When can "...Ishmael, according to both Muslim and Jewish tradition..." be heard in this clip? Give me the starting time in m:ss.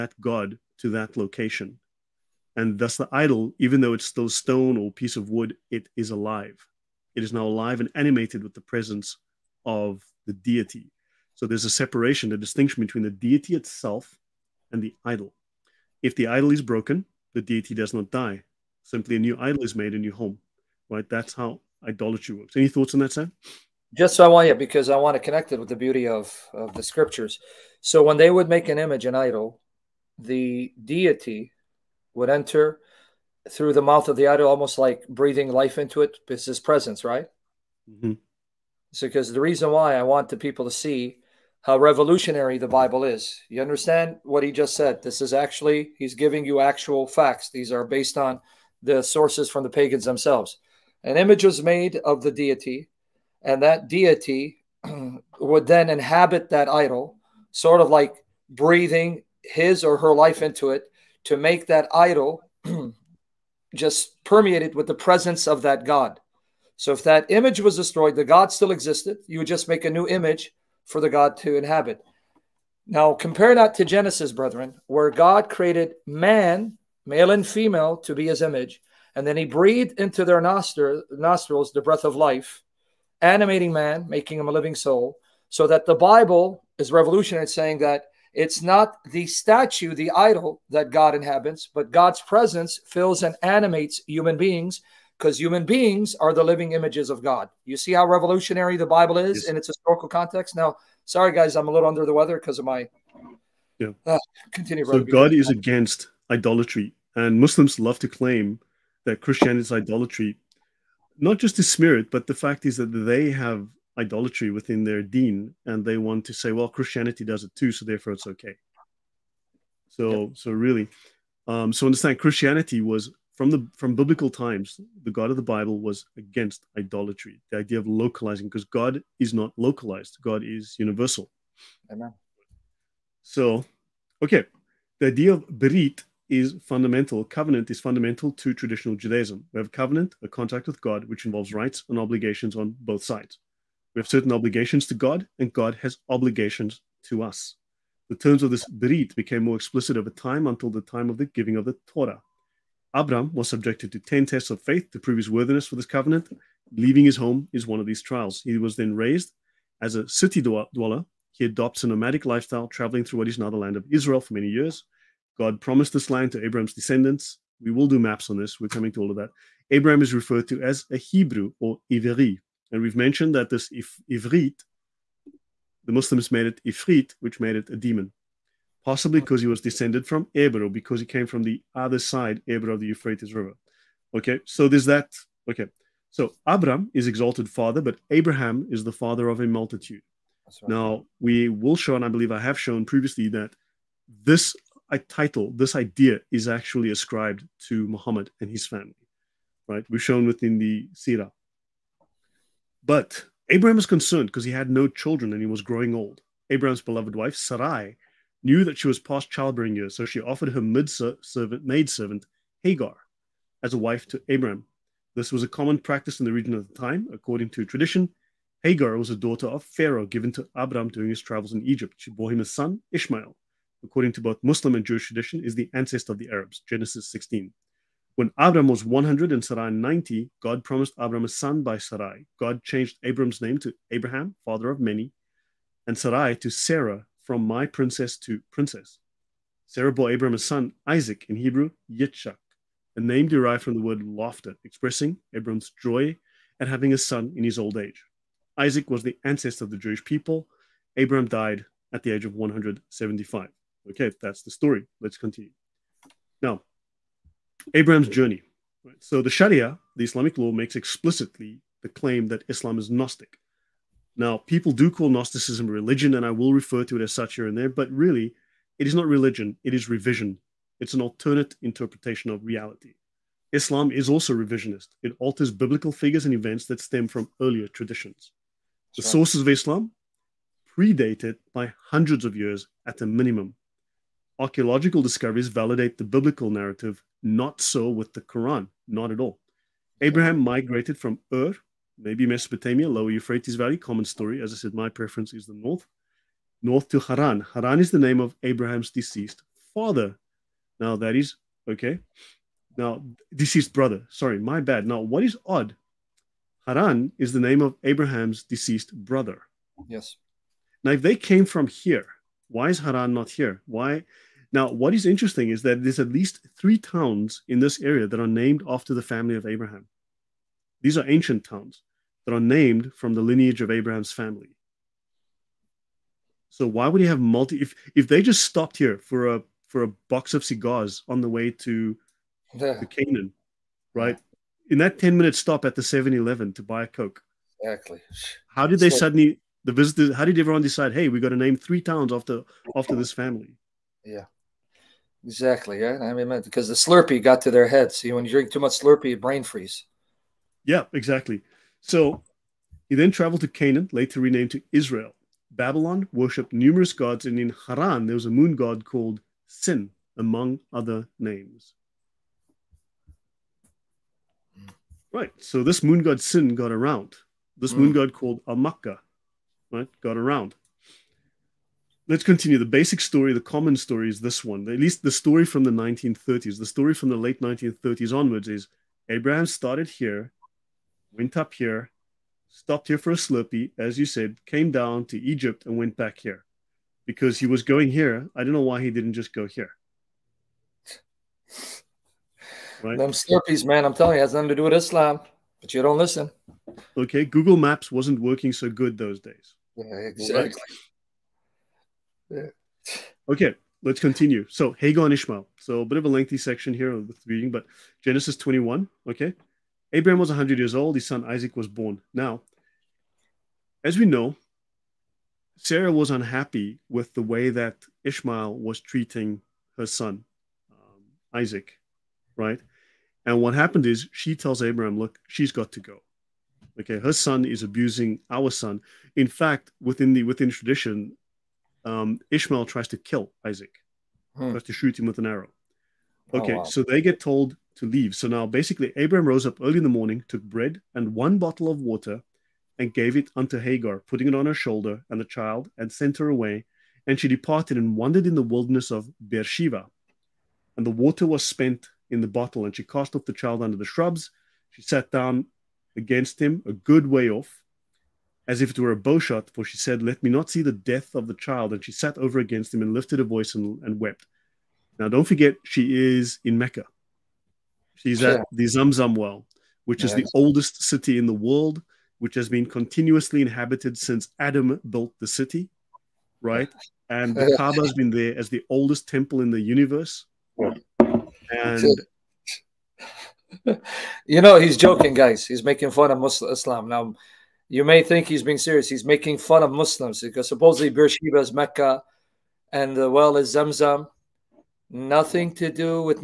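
3:42.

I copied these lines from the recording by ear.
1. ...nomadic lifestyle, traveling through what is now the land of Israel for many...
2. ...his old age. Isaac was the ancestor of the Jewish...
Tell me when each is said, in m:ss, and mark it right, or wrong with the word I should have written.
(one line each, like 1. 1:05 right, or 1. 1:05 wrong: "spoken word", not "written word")
1. 2:41 right
2. 4:07 right.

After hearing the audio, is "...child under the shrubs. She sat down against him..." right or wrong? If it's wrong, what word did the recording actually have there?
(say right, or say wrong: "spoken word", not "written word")
right.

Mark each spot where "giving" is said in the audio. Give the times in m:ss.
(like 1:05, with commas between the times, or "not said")
0:46, 2:31.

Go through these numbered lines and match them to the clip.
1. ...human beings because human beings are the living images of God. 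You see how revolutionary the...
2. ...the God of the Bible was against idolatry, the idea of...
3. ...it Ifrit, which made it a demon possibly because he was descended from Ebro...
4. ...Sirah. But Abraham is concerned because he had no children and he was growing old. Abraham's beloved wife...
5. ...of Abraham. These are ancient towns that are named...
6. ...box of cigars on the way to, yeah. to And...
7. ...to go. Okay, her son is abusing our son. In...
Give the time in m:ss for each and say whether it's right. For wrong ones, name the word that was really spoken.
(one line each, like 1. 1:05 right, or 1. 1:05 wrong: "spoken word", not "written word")
1. 1:34 right
2. 2:05 right
3. 2:56 right
4. 3:20 right
5. 5:19 right
6. 5:30 wrong: "Canaan", not "And"
7. 7:05 right.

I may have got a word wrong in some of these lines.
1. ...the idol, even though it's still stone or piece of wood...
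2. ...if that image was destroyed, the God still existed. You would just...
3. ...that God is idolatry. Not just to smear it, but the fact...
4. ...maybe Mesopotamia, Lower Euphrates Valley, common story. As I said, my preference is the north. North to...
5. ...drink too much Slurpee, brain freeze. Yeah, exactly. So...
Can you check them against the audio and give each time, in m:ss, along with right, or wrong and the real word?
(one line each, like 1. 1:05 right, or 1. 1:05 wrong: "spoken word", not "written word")
1. 0:02 right
2. 1:06 right
3. 1:49 wrong: "Christianity", not "God"
4. 4:52 right
5. 5:48 right.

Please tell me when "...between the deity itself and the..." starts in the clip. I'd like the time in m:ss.
0:12.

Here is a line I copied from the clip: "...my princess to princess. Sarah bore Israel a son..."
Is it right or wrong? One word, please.
wrong.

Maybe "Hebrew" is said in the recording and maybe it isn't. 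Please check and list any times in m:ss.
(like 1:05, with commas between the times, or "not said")
2:50, 4:01.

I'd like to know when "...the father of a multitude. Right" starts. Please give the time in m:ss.
3:08.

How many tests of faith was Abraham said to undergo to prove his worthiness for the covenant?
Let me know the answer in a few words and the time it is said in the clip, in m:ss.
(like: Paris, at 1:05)
10, at 2:33.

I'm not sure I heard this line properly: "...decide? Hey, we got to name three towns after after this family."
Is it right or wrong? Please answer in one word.
right.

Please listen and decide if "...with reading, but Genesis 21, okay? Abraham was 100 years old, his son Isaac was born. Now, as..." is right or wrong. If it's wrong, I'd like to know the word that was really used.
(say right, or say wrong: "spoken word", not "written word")
right.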